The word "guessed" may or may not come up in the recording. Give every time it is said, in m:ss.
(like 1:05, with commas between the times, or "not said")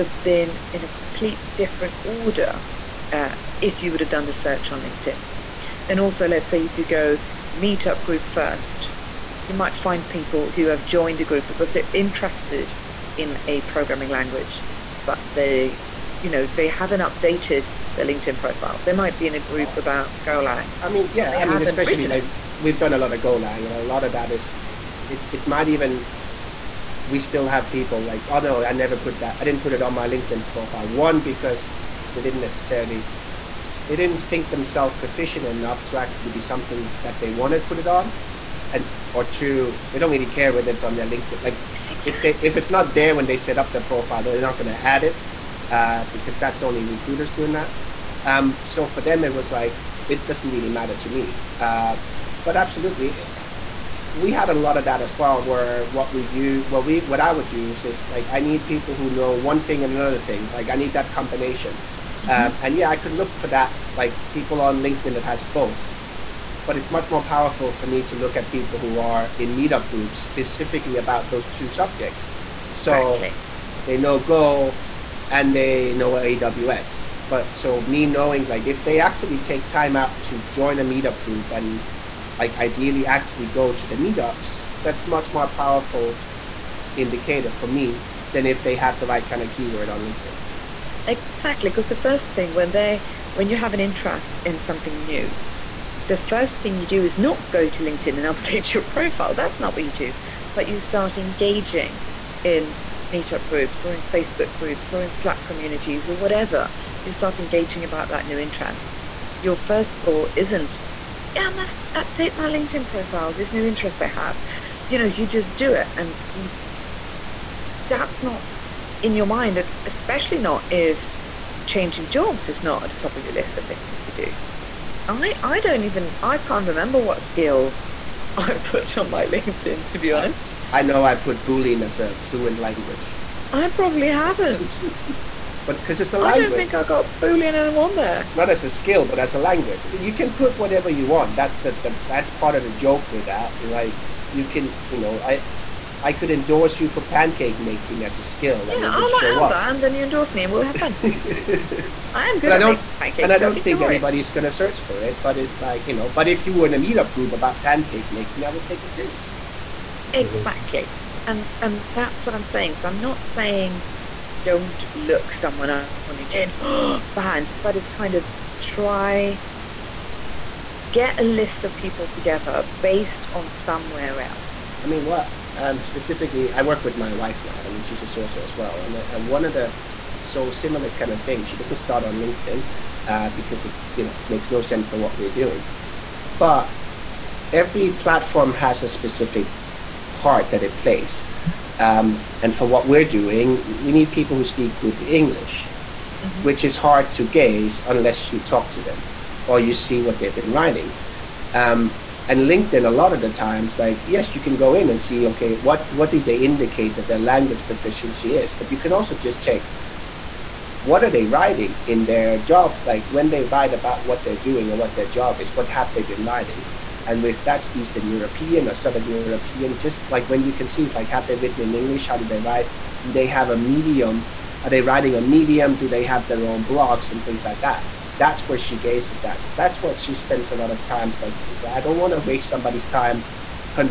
not said.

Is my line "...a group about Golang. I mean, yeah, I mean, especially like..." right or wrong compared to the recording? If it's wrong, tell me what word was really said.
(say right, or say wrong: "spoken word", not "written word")
right.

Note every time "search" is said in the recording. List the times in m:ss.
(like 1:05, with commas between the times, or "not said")
0:04, 2:34.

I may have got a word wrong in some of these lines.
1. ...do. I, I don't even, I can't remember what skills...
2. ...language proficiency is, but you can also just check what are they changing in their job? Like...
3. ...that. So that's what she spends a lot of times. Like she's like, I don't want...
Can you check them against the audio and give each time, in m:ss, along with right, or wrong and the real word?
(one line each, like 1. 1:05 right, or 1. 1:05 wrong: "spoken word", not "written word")
1. 2:04 right
2. 3:27 wrong: "writing", not "changing"
3. 3:49 right.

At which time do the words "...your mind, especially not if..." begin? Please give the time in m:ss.
1:59.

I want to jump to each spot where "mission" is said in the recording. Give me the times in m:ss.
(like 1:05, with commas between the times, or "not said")
not said.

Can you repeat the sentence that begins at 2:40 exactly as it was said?
Exactly, and and that's what I'm saying.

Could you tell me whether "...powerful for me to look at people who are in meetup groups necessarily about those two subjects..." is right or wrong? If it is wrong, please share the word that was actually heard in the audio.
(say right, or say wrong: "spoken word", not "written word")
wrong: "specifically", not "necessarily".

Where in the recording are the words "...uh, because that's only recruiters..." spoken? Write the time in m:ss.
0:45.